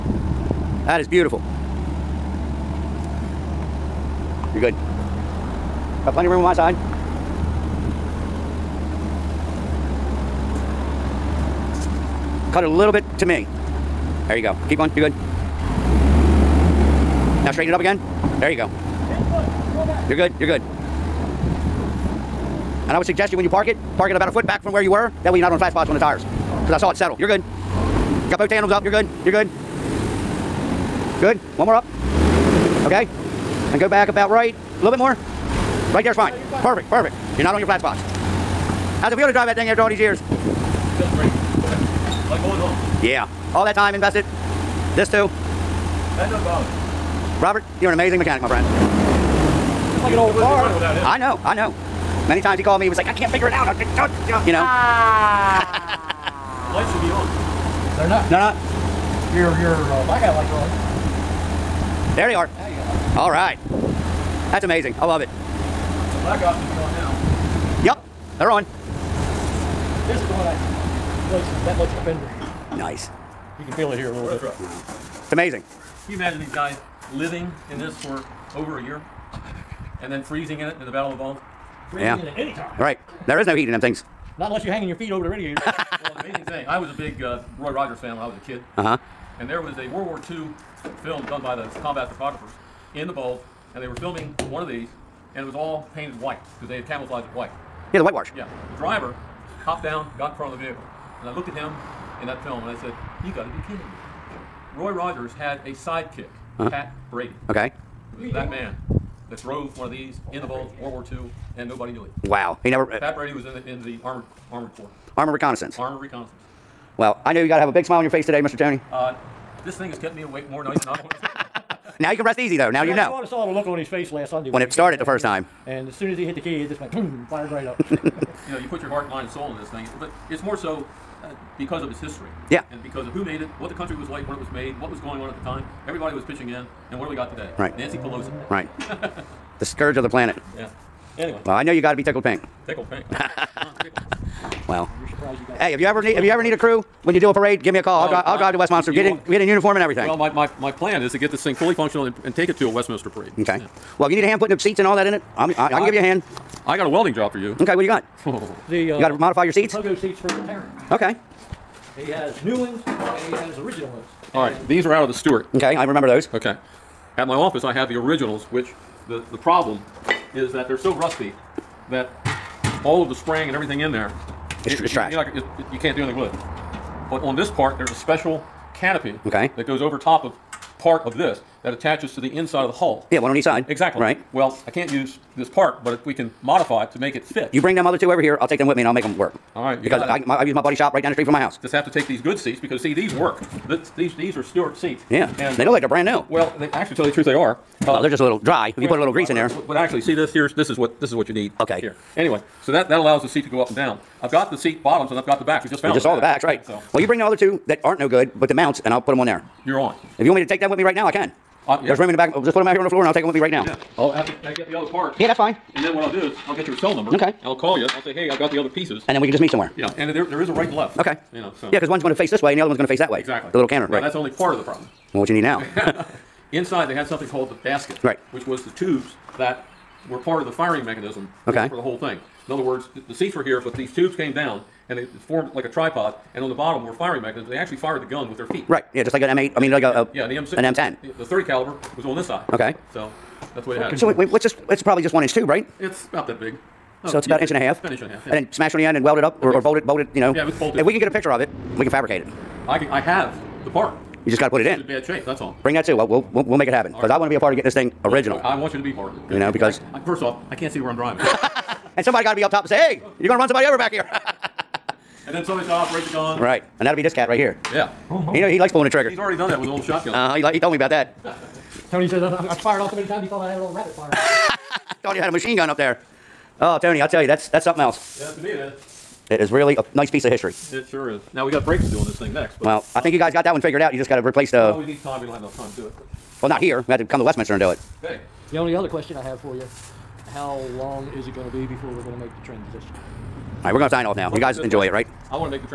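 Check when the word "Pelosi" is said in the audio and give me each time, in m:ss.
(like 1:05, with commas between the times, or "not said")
2:17.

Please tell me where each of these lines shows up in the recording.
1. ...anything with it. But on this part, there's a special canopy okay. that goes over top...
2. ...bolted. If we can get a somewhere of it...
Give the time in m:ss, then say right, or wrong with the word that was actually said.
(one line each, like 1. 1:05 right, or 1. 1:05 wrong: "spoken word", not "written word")
1. 2:56 right
2. 4:10 wrong: "picture", not "somewhere".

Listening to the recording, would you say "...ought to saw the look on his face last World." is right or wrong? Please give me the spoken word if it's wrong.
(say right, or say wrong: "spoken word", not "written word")
wrong: "Sunday", not "World".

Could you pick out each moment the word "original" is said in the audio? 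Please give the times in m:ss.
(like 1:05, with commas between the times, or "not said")
2:43, 2:47, 4:18.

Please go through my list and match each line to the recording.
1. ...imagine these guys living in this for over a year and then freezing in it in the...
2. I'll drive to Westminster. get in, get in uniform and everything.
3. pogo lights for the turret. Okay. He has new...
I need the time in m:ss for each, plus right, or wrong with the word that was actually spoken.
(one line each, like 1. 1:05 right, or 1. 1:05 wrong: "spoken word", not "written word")
1. 1:16 right
2. 2:28 right
3. 2:39 wrong: "seats", not "lights".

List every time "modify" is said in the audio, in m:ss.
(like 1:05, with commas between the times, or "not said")
2:39, 3:06.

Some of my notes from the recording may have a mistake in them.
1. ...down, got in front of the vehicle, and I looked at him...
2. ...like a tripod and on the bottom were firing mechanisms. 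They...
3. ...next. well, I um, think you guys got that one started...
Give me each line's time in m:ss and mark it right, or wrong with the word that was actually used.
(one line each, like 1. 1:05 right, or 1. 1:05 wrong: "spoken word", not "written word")
1. 1:39 right
2. 3:55 right
3. 4:42 wrong: "figured", not "started".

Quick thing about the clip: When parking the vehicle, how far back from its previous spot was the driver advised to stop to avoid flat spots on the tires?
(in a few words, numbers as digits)
About a foot.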